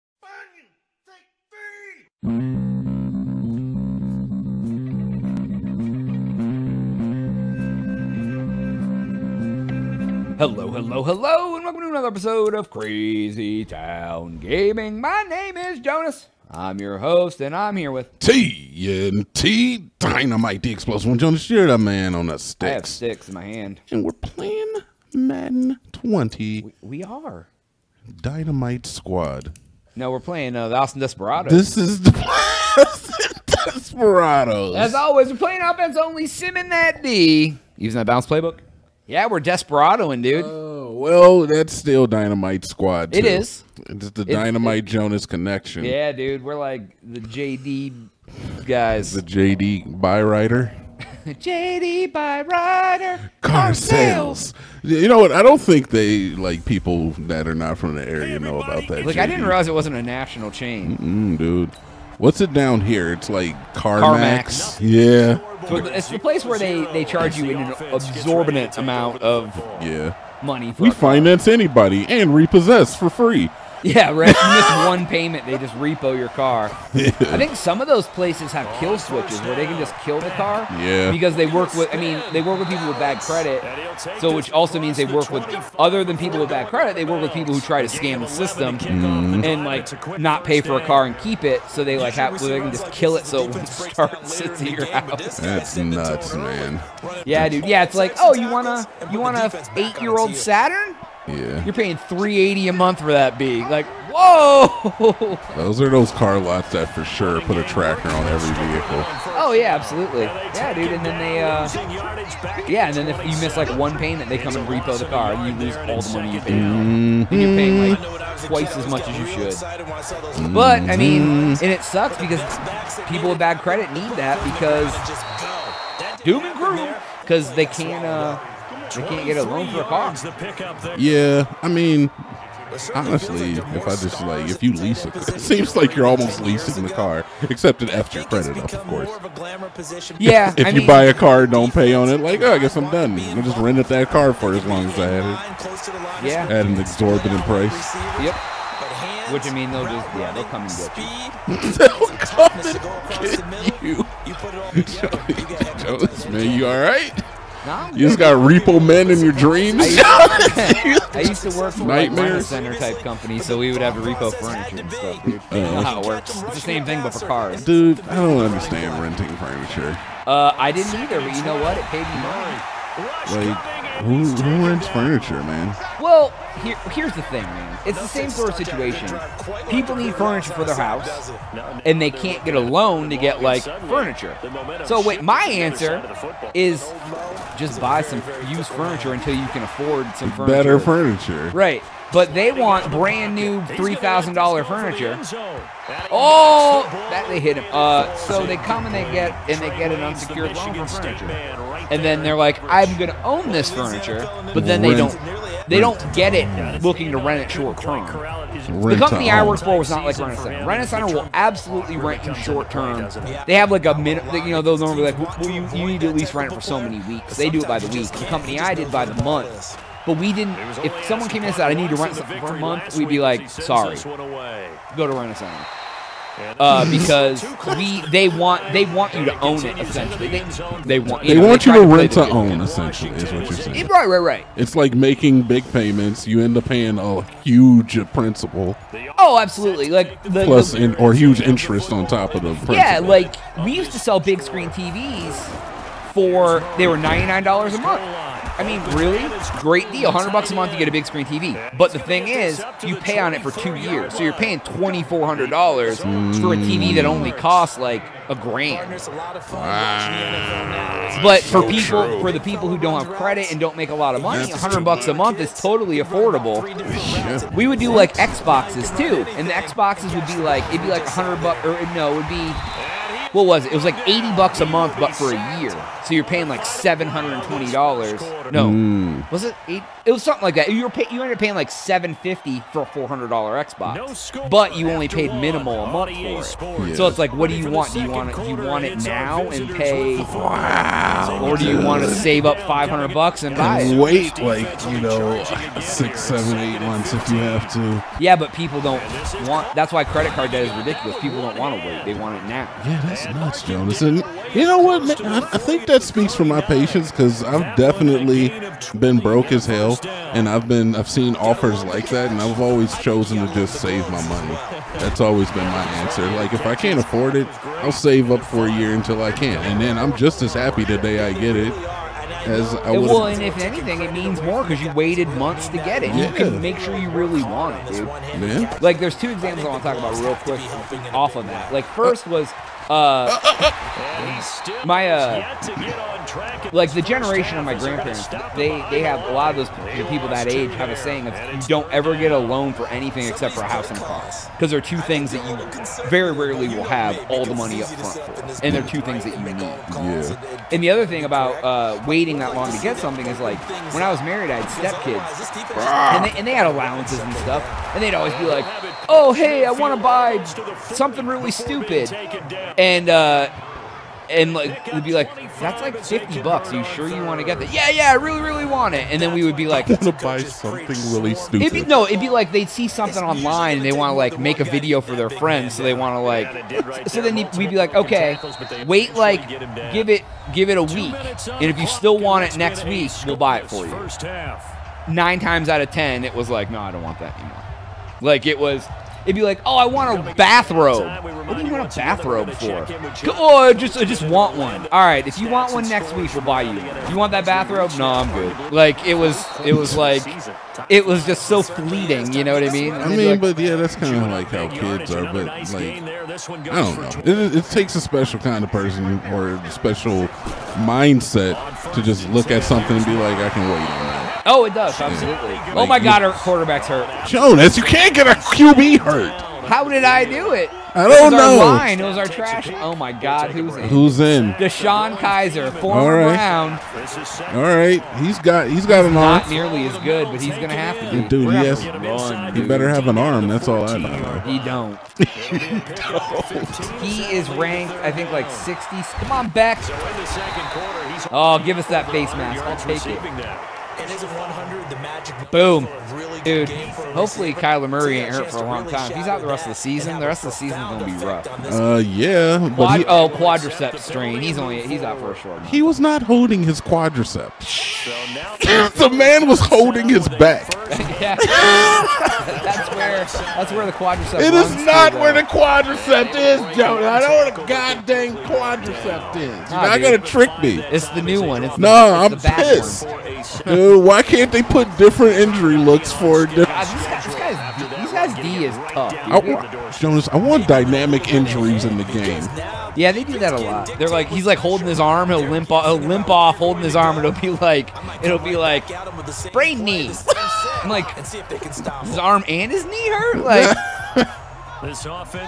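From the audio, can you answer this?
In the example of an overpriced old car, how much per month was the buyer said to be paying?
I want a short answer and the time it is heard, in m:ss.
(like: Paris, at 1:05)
380, at 1:41.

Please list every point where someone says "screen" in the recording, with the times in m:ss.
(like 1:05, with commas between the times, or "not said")
4:04, 4:11.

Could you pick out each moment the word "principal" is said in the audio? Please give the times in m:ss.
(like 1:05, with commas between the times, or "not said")
3:58, 4:02.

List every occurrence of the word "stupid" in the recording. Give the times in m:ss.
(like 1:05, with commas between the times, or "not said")
6:01, 6:11.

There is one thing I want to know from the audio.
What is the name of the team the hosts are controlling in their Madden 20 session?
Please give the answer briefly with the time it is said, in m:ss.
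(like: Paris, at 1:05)
Austin Desperados, at 0:30.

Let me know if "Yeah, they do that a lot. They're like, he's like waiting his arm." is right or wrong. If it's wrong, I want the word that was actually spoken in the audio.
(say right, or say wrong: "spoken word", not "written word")
wrong: "holding", not "waiting".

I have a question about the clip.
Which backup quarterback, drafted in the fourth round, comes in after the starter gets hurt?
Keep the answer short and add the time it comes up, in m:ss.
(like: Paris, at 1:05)
Deshaun Kaiser, at 7:04.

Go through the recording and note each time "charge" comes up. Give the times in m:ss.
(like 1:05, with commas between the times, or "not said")
1:07.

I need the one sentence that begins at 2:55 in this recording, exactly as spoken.
Well, here, here's the thing, man.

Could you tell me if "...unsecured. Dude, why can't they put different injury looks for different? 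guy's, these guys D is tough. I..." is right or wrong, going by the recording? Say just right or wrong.
wrong.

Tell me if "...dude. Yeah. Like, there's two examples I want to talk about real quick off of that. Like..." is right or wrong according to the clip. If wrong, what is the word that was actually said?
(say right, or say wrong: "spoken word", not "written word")
right.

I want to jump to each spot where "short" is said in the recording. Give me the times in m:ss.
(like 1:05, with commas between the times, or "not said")
3:27, 3:32, 7:35.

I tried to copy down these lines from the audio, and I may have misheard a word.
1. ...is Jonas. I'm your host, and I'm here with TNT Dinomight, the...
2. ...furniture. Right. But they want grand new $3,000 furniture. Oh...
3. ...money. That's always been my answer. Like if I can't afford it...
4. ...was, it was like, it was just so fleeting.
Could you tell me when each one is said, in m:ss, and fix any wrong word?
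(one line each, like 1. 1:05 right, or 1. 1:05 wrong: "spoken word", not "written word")
1. 0:15 right
2. 3:10 wrong: "brand", not "grand"
3. 5:14 right
4. 6:39 right.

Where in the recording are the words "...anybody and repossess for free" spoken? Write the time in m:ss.
1:11.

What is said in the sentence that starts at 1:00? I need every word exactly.
Mm-mm, dude, what's it down here?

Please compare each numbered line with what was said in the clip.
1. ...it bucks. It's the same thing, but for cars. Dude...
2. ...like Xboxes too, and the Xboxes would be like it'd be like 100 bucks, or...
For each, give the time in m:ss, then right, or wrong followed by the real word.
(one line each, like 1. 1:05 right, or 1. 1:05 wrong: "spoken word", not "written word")
1. 2:45 wrong: "works", not "bucks"
2. 4:27 right.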